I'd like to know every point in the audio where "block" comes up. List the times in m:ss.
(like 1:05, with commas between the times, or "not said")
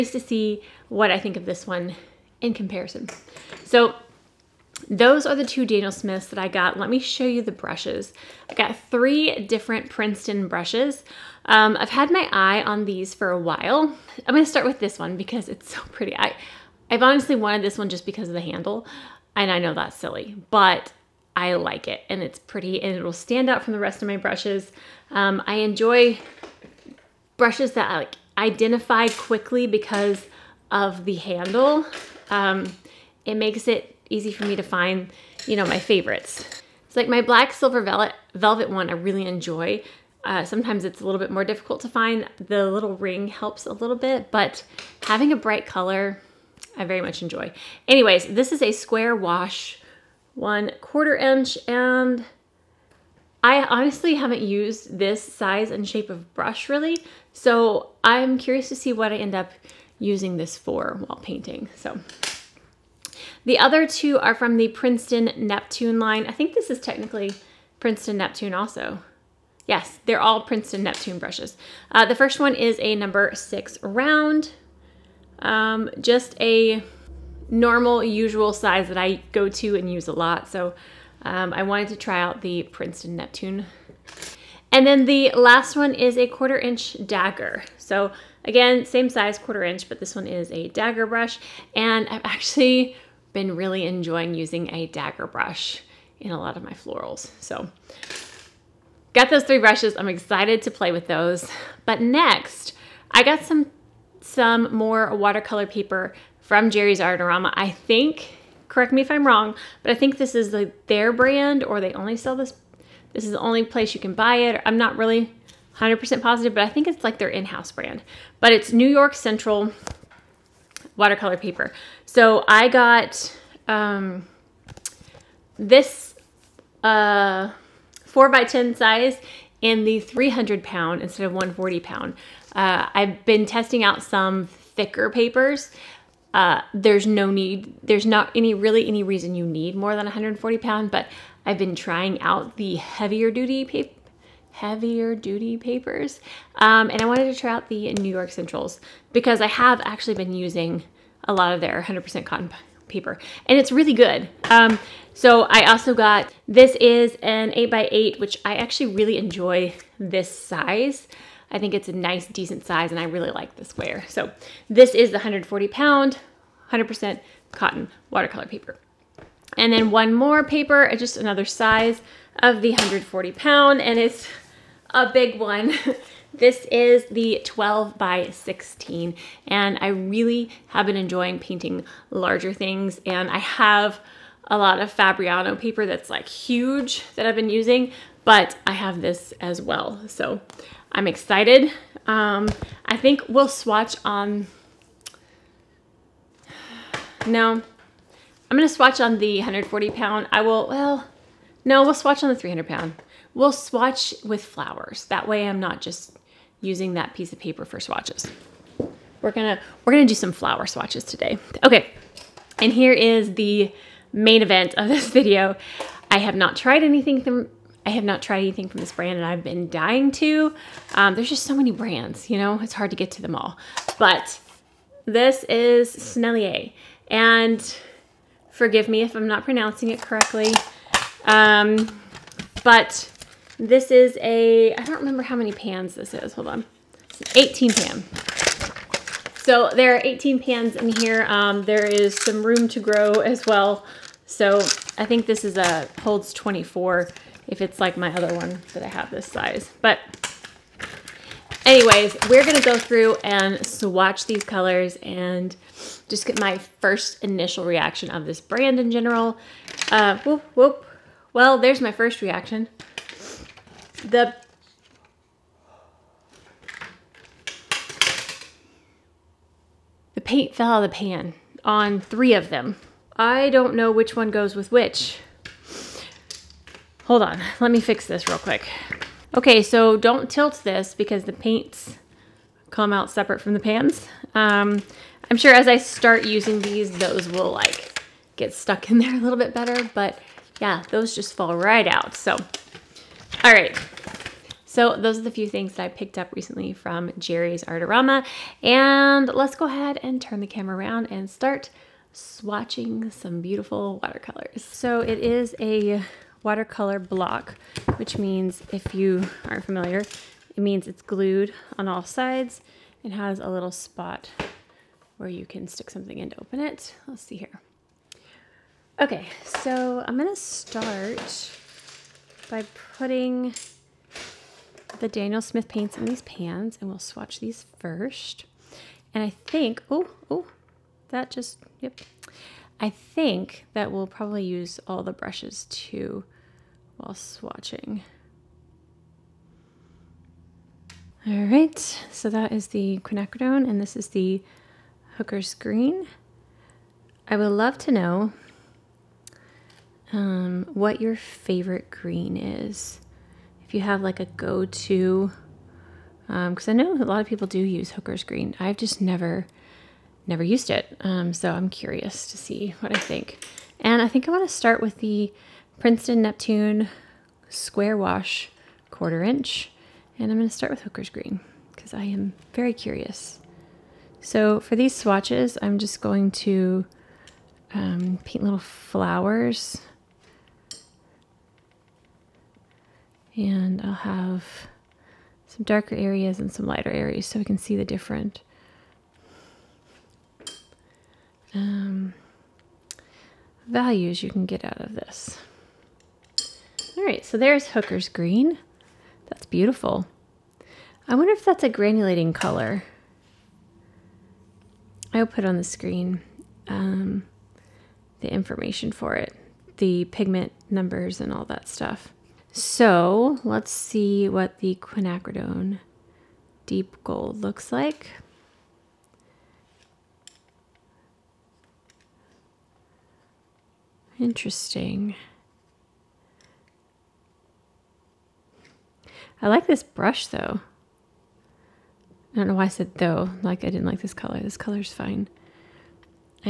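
5:06.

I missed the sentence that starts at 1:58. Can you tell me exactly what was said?
But it's New York Central watercolor paper.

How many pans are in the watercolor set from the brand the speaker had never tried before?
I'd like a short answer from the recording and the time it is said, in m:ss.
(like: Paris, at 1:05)
18, at 3:57.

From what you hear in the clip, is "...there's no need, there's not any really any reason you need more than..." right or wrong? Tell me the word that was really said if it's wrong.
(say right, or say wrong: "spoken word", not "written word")
right.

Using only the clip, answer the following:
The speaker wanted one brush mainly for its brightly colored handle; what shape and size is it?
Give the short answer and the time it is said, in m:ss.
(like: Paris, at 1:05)
Square wash, 1/4 inch, at 0:48.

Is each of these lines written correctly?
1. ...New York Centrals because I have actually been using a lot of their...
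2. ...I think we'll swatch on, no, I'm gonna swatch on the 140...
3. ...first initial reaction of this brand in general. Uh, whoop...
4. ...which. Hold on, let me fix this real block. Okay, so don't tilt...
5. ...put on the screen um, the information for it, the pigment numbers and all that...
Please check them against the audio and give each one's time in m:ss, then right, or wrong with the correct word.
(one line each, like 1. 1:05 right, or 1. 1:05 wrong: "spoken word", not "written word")
1. 2:27 right
2. 3:12 right
3. 4:16 right
4. 4:34 wrong: "quick", not "block"
5. 6:45 right.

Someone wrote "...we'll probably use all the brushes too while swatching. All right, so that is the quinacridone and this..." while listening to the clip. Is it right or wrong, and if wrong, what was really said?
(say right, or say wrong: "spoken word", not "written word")
right.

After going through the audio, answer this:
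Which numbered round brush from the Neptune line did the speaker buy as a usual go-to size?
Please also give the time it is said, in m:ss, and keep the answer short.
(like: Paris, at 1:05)
Number 6, at 1:12.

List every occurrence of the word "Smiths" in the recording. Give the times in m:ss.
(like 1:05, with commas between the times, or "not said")
0:05, 5:25.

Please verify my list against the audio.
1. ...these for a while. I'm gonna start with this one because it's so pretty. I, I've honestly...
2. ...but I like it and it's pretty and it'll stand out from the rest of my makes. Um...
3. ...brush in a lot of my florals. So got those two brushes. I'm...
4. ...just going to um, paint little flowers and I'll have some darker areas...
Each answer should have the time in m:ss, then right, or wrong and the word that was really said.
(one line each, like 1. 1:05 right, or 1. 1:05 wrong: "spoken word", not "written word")
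1. 0:12 right
2. 0:20 wrong: "brushes", not "makes"
3. 1:35 wrong: "three", not "two"
4. 6:15 right.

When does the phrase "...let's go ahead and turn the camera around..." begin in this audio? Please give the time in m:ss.
4:59.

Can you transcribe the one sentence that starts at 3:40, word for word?
Um, there's just so many brands, you know, it's hard to get to them all.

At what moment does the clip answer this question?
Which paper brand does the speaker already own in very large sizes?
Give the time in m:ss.
3:04.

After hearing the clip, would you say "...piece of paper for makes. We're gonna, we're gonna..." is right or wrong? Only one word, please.
wrong.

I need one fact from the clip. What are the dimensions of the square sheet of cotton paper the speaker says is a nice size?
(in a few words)
8x8.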